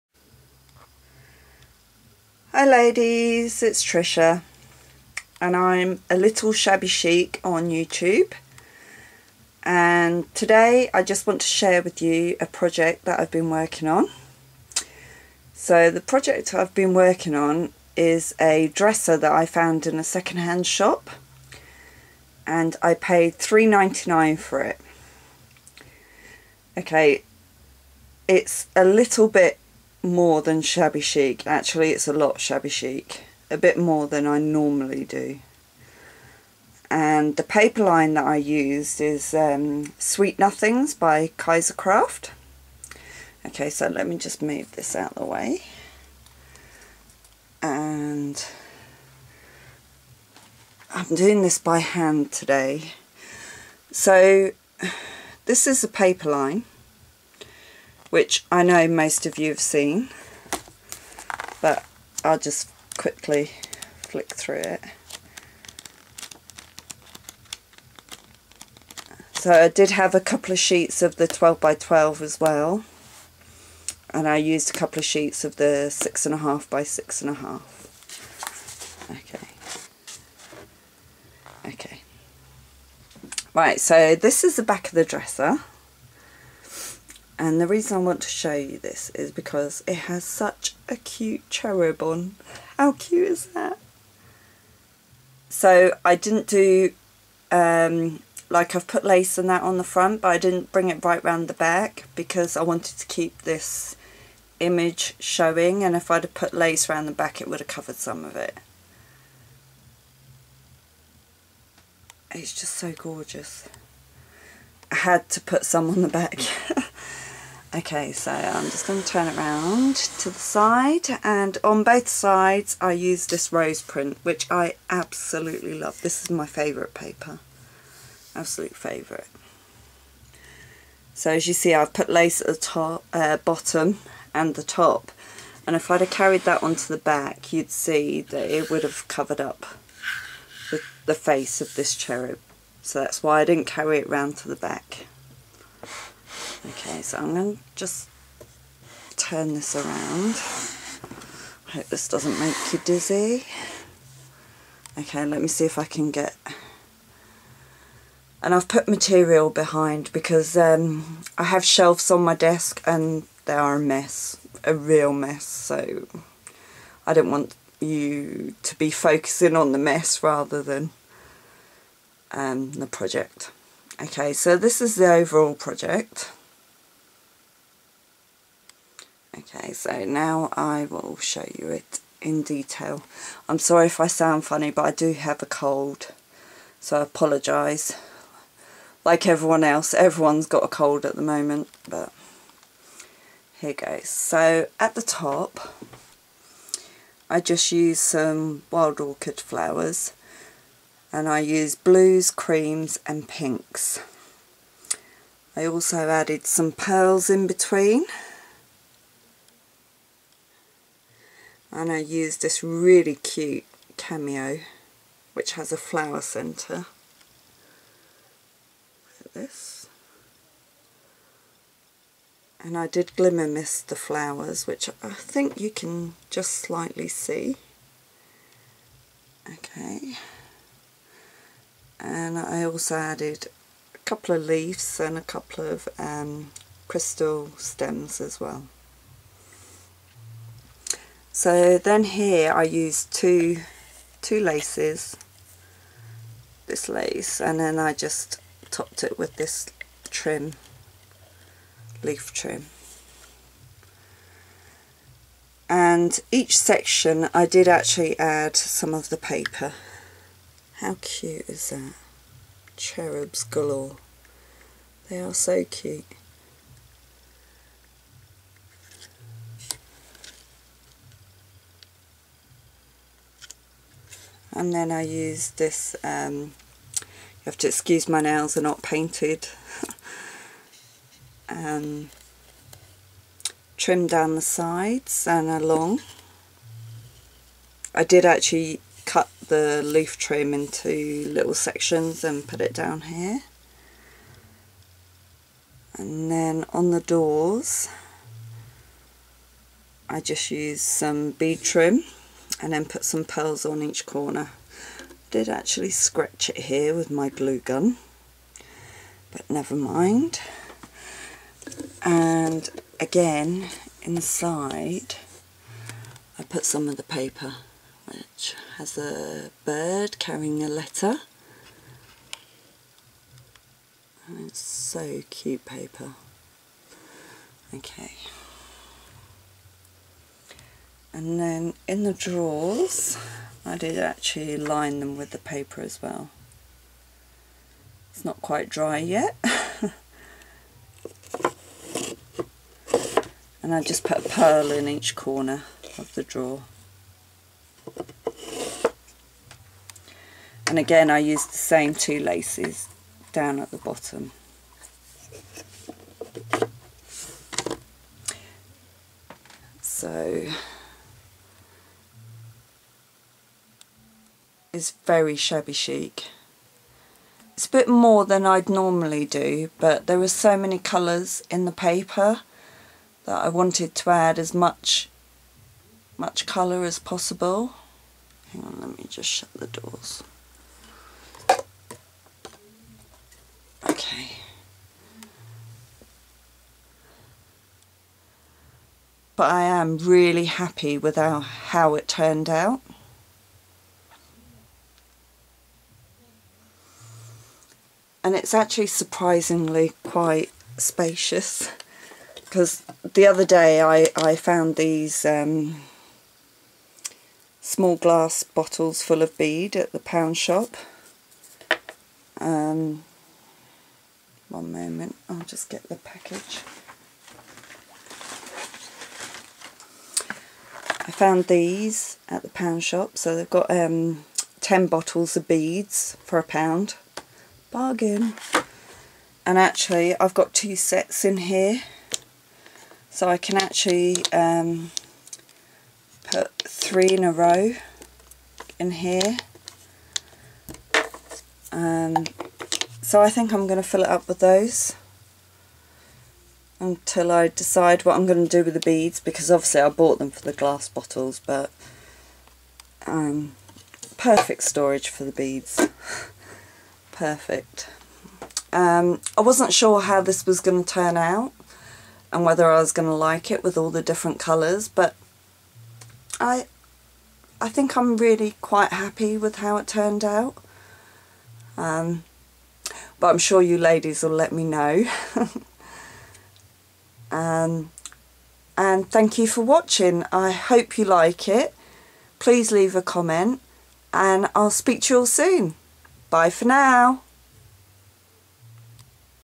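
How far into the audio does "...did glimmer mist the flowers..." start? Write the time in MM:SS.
03:42.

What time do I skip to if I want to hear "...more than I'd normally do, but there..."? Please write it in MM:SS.
06:07.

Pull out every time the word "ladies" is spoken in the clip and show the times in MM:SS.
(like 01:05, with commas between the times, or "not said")
00:02, 07:53.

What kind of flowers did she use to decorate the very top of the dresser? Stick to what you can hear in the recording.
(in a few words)
wild orchid.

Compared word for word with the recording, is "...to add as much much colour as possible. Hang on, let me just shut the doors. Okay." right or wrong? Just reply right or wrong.
right.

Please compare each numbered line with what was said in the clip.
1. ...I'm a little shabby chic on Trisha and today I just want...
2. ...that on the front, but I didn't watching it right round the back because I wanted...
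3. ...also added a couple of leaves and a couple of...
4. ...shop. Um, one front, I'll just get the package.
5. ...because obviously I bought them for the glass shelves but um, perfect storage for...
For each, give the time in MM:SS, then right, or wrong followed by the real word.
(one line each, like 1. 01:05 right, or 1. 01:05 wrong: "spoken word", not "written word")
1. 00:05 wrong: "YouTube", not "Trisha"
2. 01:39 wrong: "bring", not "watching"
3. 03:52 right
4. 06:50 wrong: "moment", not "front"
5. 07:29 wrong: "bottles", not "shelves".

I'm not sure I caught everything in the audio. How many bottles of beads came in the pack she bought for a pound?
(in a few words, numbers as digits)
10.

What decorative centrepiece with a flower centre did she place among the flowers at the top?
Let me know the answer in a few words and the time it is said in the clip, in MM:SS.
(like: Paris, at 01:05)
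cameo, at 03:33.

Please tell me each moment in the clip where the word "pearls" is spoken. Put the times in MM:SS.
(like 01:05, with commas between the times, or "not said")
03:26, 05:03, 05:44.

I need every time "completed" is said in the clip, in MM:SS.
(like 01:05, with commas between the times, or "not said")
not said.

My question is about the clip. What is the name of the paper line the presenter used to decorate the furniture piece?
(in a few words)
Sweet Nothings.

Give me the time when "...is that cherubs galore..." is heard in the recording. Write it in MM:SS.
04:21.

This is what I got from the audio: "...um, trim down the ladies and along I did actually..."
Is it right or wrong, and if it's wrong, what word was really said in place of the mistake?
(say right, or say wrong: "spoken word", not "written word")
wrong: "sides", not "ladies".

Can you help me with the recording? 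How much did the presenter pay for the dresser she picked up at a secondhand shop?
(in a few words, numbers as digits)
$3.99.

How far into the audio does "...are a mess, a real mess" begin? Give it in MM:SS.
02:43.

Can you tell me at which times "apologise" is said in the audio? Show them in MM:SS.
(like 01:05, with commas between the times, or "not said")
03:07.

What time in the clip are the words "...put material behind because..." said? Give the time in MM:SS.
02:38.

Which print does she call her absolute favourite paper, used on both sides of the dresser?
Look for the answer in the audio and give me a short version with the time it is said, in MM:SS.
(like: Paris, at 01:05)
rose print, at 02:03.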